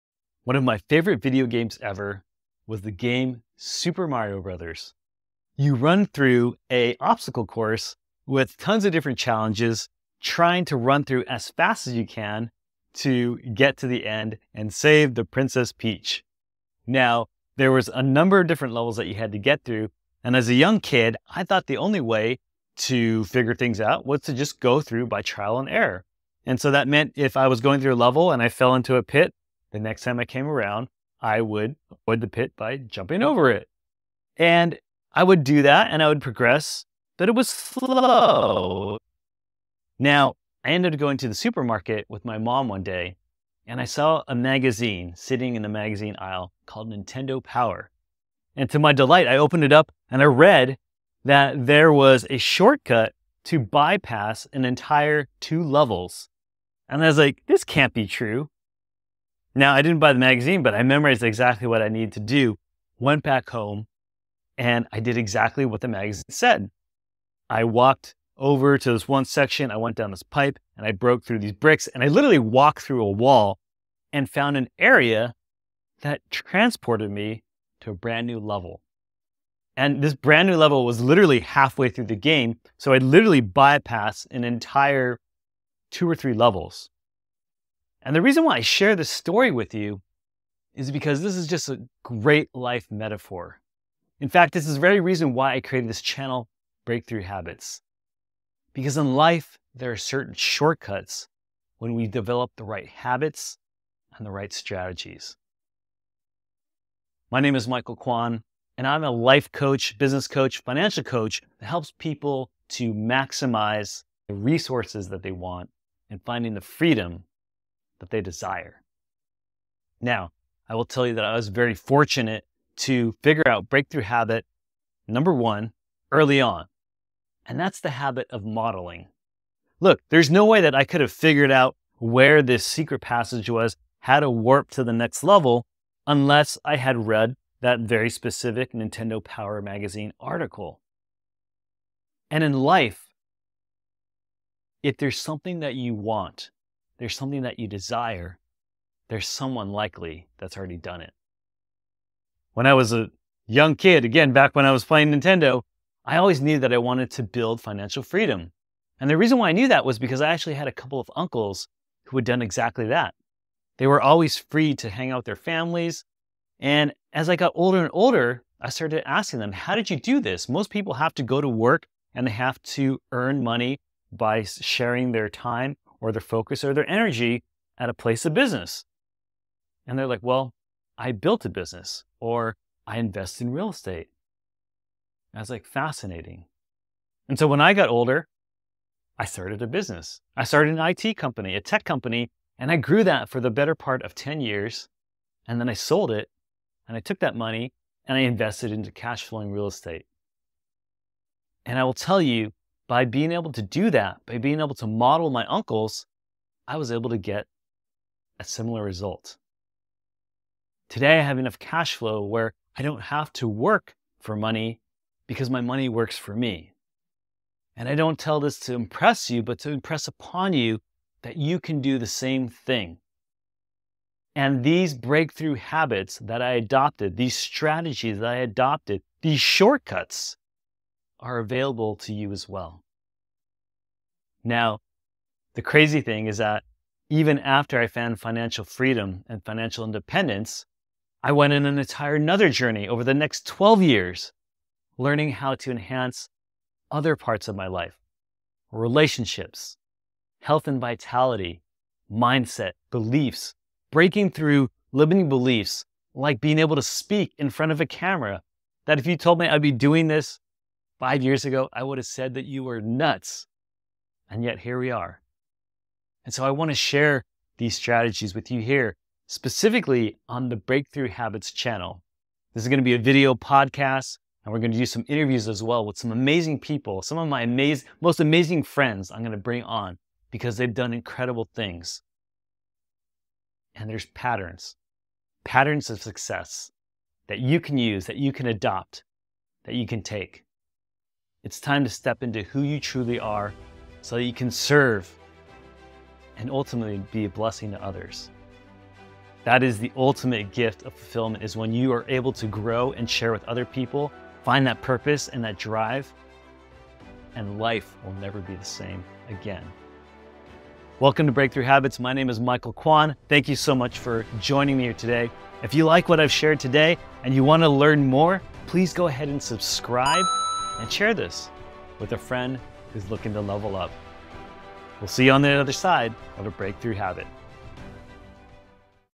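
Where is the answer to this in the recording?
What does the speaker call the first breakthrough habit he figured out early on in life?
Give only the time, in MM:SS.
02:08.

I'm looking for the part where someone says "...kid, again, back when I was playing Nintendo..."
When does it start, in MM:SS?
02:33.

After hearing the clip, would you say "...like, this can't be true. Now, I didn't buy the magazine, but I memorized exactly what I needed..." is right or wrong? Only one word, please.
right.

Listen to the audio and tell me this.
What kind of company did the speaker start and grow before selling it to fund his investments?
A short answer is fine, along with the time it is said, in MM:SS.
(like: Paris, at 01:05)
IT company, at 03:10.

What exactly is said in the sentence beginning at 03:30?
Today, I have enough cash flow where I don't have to work for money because my money works for me.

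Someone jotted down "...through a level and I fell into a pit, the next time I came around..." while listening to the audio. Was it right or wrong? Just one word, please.
right.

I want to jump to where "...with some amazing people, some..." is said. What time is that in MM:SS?
04:35.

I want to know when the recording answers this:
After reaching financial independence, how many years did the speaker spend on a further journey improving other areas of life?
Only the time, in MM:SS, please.
04:03.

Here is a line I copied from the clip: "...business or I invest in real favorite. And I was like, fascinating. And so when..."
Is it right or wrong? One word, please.
wrong.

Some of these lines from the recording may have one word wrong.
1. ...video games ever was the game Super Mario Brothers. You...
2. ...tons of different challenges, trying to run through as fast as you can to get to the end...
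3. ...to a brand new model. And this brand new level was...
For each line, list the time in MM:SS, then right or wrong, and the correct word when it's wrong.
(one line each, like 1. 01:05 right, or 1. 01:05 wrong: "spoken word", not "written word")
1. 00:01 right
2. 00:08 right
3. 01:17 wrong: "level", not "model".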